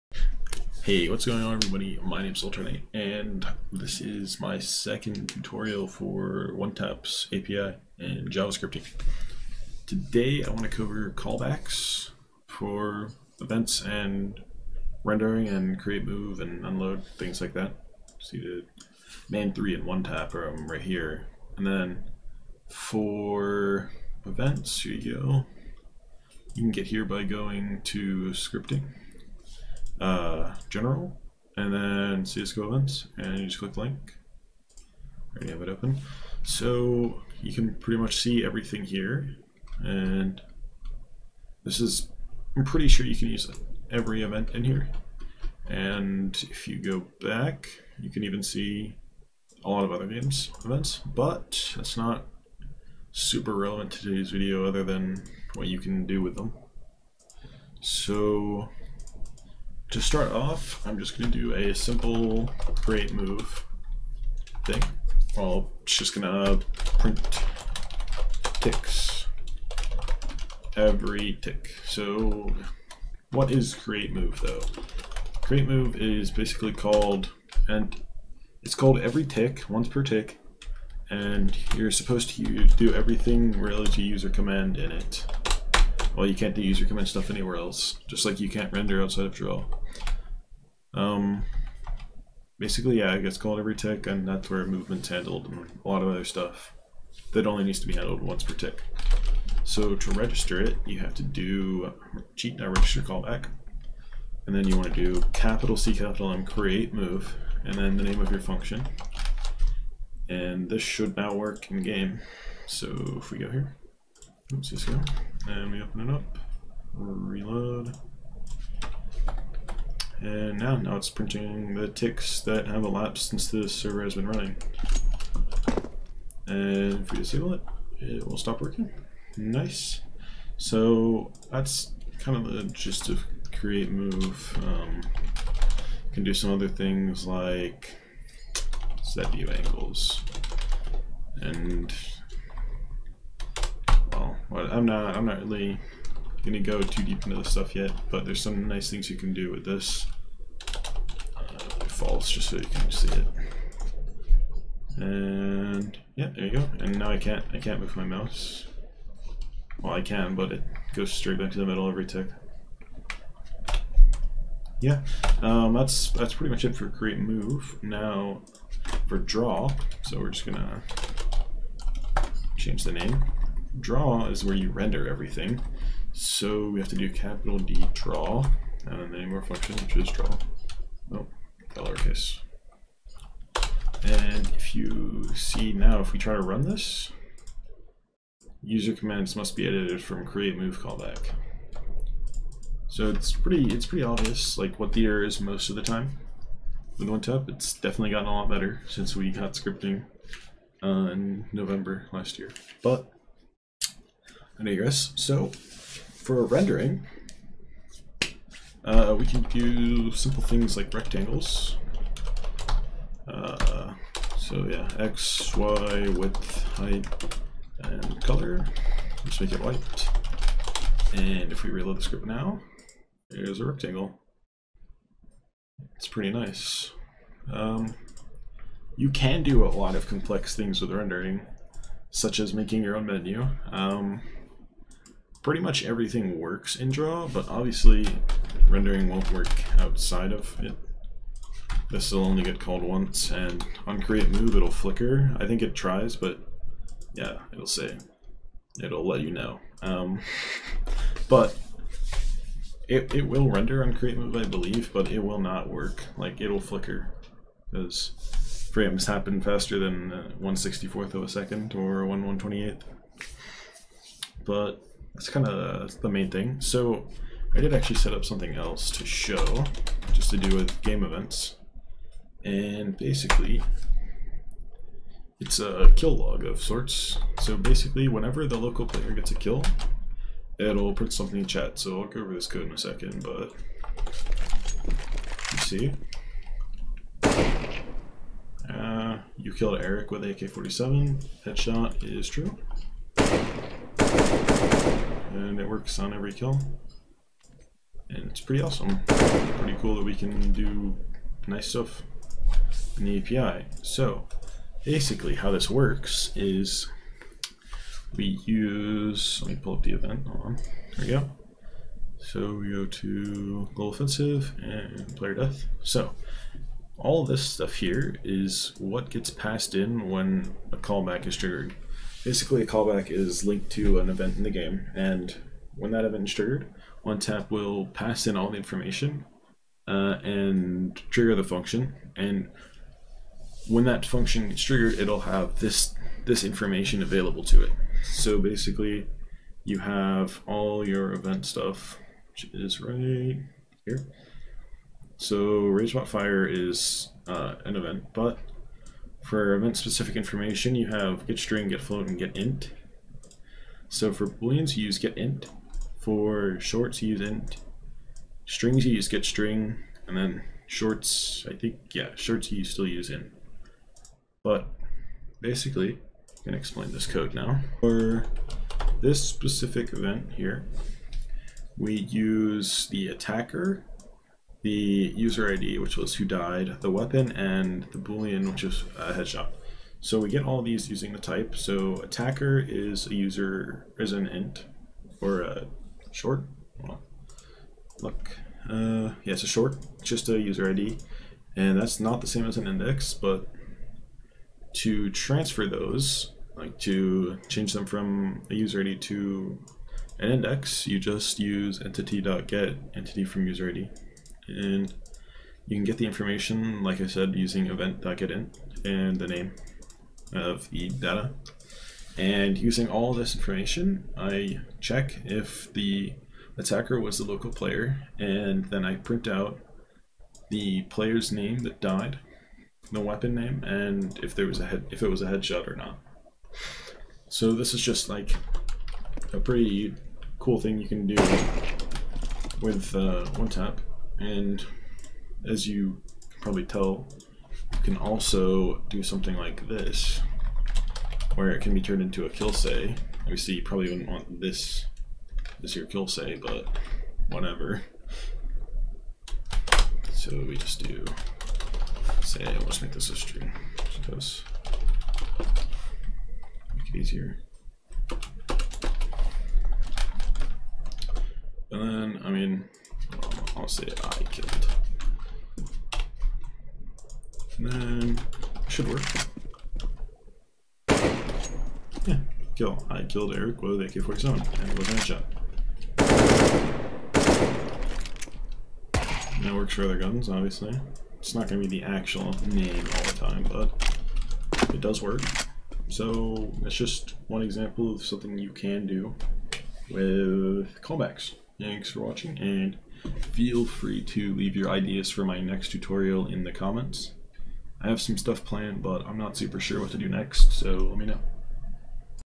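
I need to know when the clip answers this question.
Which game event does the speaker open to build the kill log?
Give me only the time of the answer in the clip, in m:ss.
5:15.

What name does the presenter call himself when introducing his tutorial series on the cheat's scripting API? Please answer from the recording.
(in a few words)
Ultranite.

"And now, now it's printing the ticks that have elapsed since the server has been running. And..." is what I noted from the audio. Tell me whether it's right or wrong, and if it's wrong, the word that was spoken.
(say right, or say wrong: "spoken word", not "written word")
right.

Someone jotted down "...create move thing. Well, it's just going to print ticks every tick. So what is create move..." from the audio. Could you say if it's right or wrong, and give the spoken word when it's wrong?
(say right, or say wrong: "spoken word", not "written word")
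right.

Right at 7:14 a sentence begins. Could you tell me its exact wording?
And as you can probably tell, you can also do something like this, where it can be turned into a kill say.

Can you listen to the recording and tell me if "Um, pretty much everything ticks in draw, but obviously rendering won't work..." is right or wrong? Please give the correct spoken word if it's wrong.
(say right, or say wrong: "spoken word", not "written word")
wrong: "works", not "ticks".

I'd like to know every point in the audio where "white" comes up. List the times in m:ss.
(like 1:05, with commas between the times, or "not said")
3:39.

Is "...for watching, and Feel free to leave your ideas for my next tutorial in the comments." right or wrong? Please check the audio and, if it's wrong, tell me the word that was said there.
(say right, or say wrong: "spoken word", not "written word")
right.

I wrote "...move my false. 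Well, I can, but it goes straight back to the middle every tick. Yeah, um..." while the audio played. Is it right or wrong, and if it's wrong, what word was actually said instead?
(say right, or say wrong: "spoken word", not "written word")
wrong: "mouse", not "false".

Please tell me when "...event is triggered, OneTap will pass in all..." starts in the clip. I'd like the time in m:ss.
5:26.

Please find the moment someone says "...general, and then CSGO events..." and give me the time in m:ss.
0:30.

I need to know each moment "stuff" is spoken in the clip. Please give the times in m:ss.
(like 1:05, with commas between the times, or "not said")
1:27, 1:36, 2:27, 5:01, 5:17, 5:41, 8:18.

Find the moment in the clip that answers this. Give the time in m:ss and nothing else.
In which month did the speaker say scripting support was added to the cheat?
3:21.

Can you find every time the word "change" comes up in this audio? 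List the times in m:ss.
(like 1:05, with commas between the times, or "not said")
2:52, 6:37.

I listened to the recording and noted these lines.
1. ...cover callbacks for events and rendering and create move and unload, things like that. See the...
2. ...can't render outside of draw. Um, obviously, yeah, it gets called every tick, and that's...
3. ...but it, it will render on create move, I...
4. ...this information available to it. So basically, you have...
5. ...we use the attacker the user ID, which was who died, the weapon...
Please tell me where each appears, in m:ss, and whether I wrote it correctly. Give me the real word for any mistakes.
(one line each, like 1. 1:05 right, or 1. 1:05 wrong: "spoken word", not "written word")
1. 0:10 right
2. 1:28 wrong: "basically", not "obviously"
3. 4:11 right
4. 5:36 right
5. 6:11 right.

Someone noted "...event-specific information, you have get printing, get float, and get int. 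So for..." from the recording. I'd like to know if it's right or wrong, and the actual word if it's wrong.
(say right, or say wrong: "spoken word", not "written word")
wrong: "string", not "printing".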